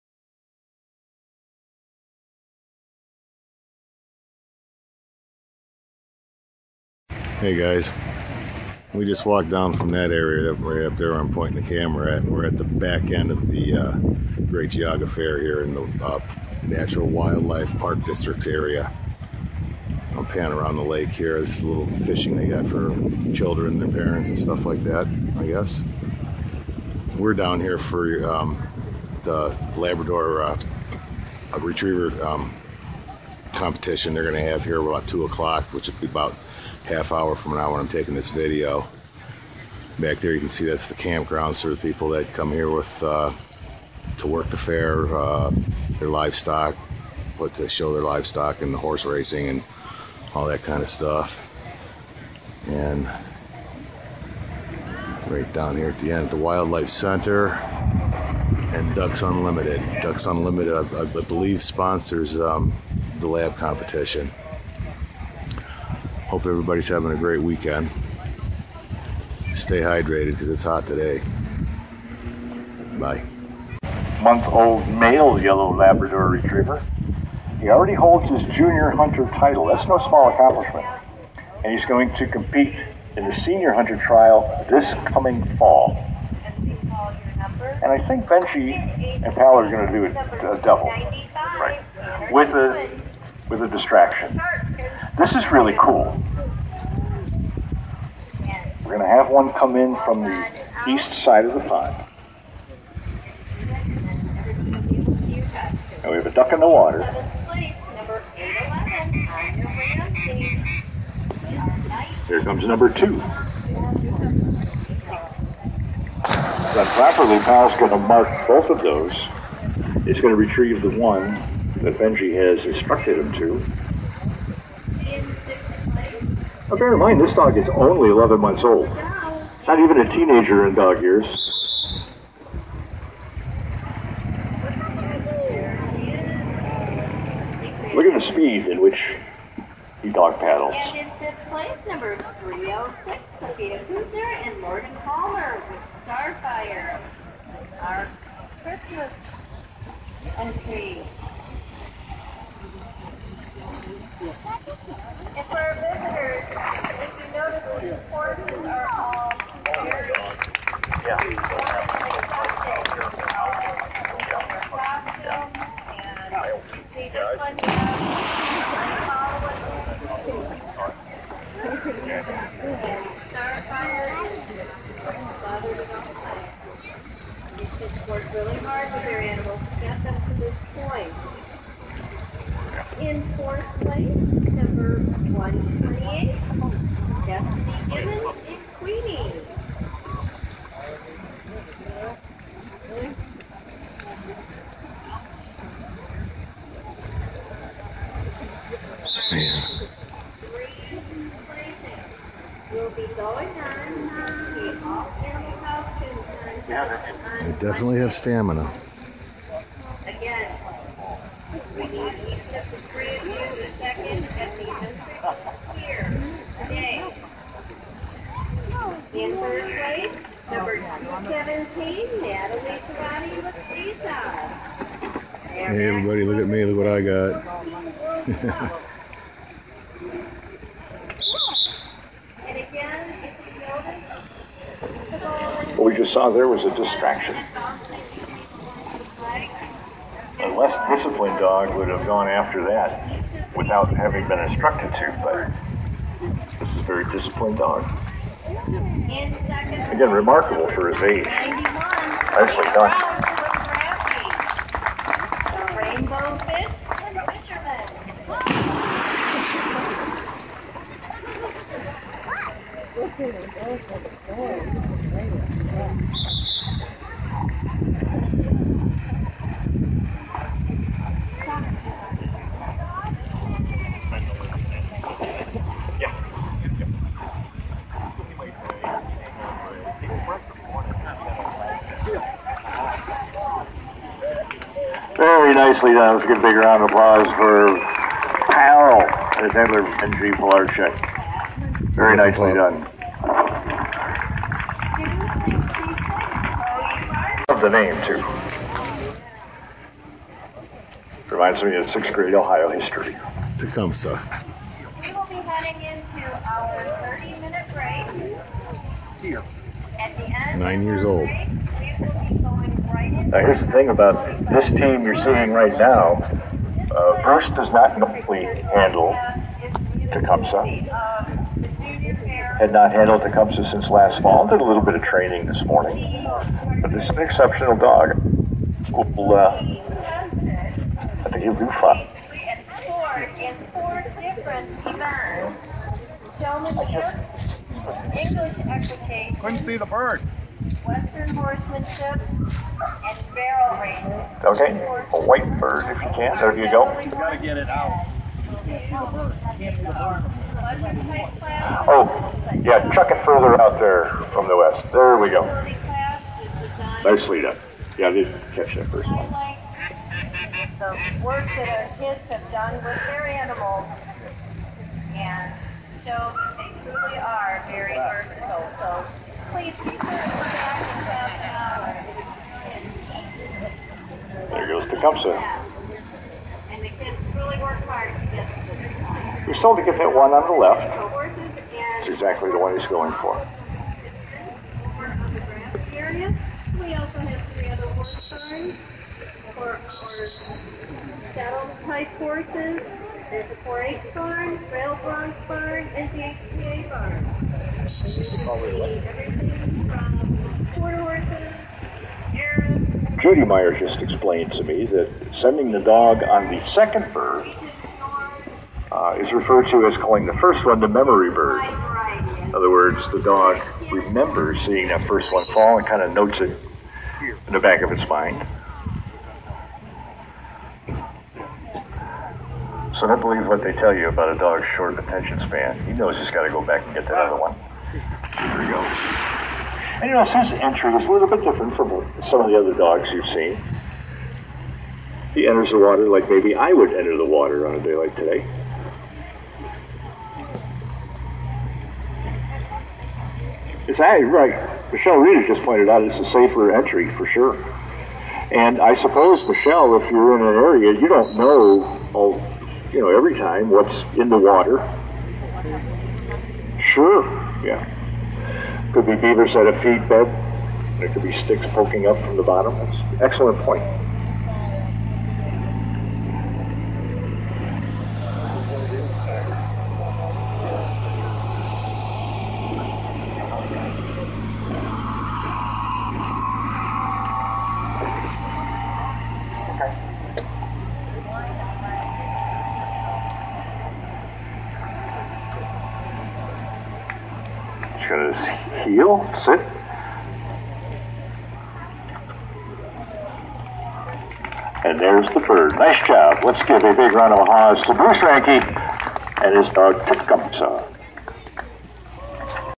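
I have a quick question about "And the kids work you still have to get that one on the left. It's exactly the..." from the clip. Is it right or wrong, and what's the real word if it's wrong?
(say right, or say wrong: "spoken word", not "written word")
right.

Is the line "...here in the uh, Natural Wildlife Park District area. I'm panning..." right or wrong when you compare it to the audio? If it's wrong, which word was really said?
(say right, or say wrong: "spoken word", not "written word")
right.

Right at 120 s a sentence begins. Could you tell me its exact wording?
It's going to retrieve the one that Benji has instructed him to.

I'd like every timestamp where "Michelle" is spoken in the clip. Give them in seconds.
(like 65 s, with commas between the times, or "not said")
444 s, 449 s.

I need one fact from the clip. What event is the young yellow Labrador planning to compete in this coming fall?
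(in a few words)
senior hunter trial.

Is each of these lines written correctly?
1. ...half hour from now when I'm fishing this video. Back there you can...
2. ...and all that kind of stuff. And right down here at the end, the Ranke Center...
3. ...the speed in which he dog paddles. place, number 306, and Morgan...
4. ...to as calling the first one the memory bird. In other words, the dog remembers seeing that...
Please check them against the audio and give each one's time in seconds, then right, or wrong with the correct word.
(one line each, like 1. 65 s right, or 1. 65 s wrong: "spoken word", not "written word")
1. 36 s wrong: "taking", not "fishing"
2. 49 s wrong: "Wildlife", not "Ranke"
3. 138 s right
4. 409 s right.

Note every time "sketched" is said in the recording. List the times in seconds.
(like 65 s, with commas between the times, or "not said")
not said.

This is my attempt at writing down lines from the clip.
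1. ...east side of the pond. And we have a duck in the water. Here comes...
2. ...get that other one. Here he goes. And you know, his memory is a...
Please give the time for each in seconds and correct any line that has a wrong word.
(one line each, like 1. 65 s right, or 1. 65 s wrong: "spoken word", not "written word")
1. 100 s right
2. 426 s wrong: "entry", not "memory".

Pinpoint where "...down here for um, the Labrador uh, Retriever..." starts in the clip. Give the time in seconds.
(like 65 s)
27 s.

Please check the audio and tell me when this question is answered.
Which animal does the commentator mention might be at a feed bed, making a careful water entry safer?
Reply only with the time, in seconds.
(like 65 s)
459 s.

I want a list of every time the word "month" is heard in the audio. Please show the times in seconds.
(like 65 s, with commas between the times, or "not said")
74 s, 128 s.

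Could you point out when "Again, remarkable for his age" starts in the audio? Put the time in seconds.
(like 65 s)
248 s.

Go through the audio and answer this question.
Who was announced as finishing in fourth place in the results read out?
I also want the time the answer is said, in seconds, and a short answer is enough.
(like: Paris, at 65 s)
Destiny Gibbons, at 187 s.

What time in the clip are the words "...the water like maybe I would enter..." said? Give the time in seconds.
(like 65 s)
435 s.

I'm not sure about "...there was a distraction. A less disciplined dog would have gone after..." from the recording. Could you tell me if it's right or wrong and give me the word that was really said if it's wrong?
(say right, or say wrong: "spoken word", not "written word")
right.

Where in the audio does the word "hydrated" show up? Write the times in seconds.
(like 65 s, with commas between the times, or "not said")
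69 s.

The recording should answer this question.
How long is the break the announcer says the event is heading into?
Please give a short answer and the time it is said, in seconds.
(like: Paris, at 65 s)
30 minutes, at 307 s.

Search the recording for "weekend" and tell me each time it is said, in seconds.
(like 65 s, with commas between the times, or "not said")
67 s.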